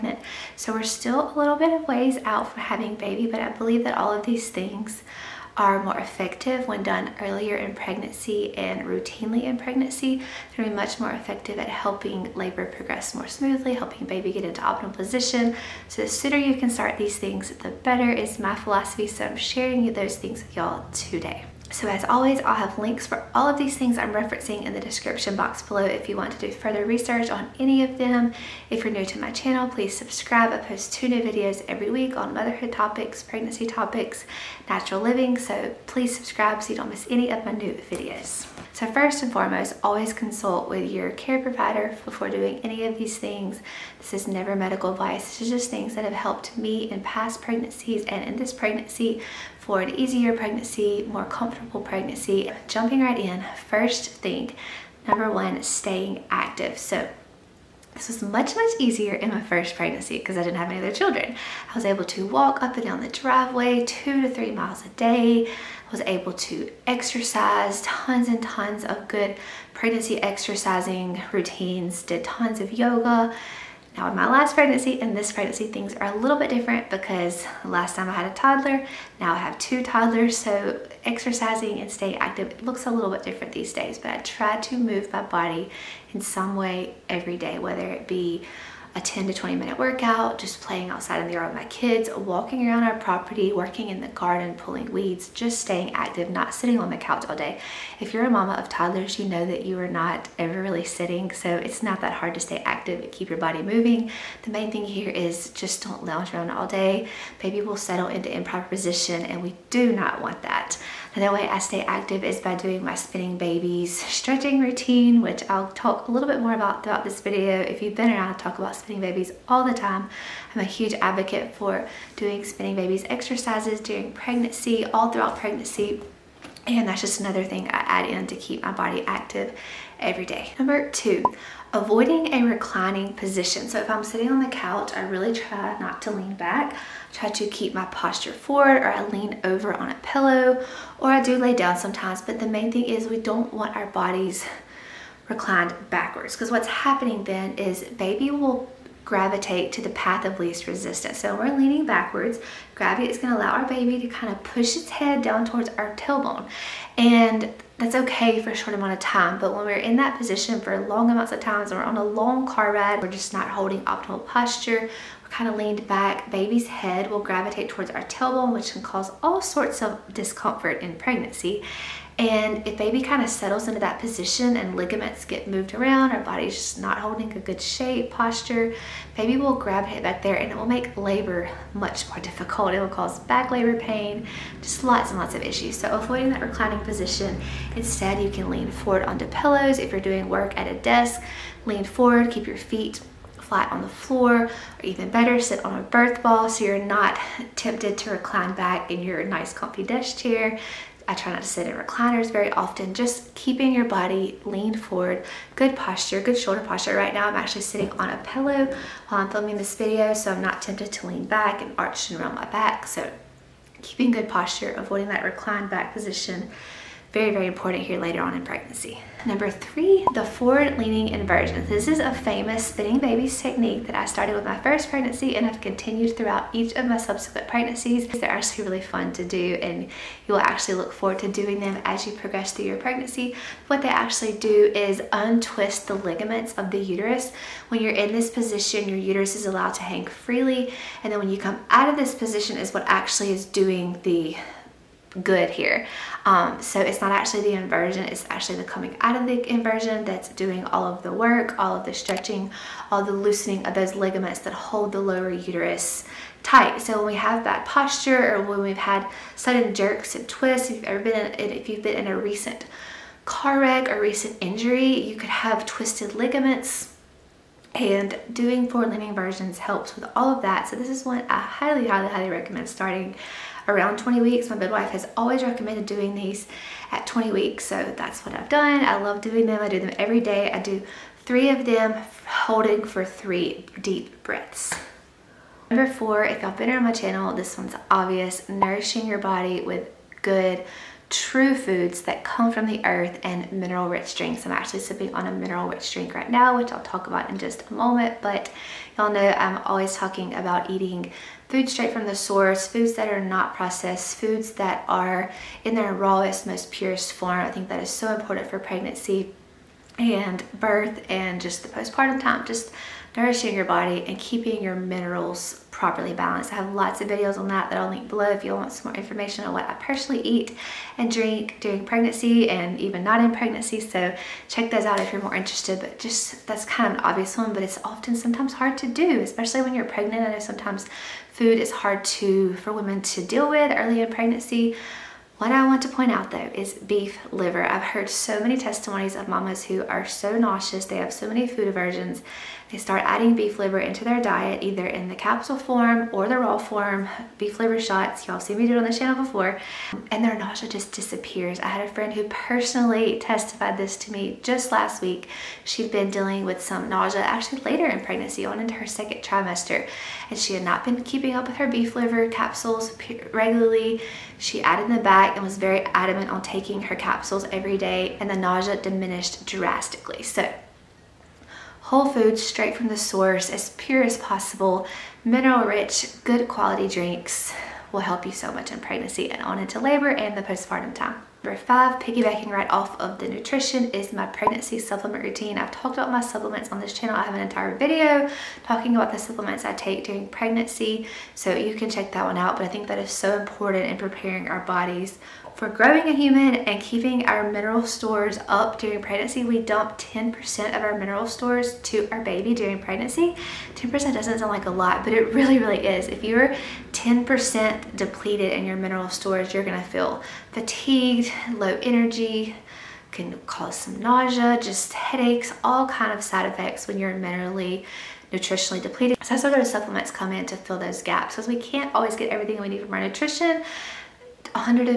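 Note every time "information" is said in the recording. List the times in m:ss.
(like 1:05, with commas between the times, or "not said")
5:18.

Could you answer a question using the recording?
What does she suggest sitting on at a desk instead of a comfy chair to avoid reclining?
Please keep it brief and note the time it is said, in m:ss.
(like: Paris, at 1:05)
birth ball, at 3:15.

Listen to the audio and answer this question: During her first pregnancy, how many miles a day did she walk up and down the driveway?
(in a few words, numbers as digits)
2 to 3 miles.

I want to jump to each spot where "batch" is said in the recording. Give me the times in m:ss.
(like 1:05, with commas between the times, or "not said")
not said.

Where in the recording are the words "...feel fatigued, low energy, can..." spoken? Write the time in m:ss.
6:49.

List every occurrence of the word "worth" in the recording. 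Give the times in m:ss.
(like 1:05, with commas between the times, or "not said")
not said.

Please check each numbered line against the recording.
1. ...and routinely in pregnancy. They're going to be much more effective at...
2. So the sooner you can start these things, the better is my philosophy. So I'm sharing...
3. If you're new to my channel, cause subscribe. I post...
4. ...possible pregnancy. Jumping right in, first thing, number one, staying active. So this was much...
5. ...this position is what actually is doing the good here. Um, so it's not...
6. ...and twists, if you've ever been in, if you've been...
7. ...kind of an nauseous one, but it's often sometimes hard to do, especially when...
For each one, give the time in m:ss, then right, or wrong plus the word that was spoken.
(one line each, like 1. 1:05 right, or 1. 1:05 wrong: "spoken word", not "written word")
1. 0:08 right
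2. 0:15 right
3. 0:28 wrong: "please", not "cause"
4. 0:51 wrong: "comfortable", not "possible"
5. 4:01 right
6. 4:20 right
7. 5:26 wrong: "obvious", not "nauseous".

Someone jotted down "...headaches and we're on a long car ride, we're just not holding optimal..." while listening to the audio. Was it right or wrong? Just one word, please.
wrong.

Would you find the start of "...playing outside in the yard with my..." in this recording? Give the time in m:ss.
1:30.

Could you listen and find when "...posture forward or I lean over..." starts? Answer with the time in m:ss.
2:17.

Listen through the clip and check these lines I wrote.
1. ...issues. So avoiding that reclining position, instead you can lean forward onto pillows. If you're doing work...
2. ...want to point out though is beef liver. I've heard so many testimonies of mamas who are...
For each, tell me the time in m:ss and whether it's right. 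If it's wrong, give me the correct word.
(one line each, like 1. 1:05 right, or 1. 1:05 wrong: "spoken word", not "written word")
1. 3:05 right
2. 5:35 right.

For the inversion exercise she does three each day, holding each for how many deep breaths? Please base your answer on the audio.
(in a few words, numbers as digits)
3.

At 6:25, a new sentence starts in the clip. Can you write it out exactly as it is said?
I've talked about my supplements on this channel.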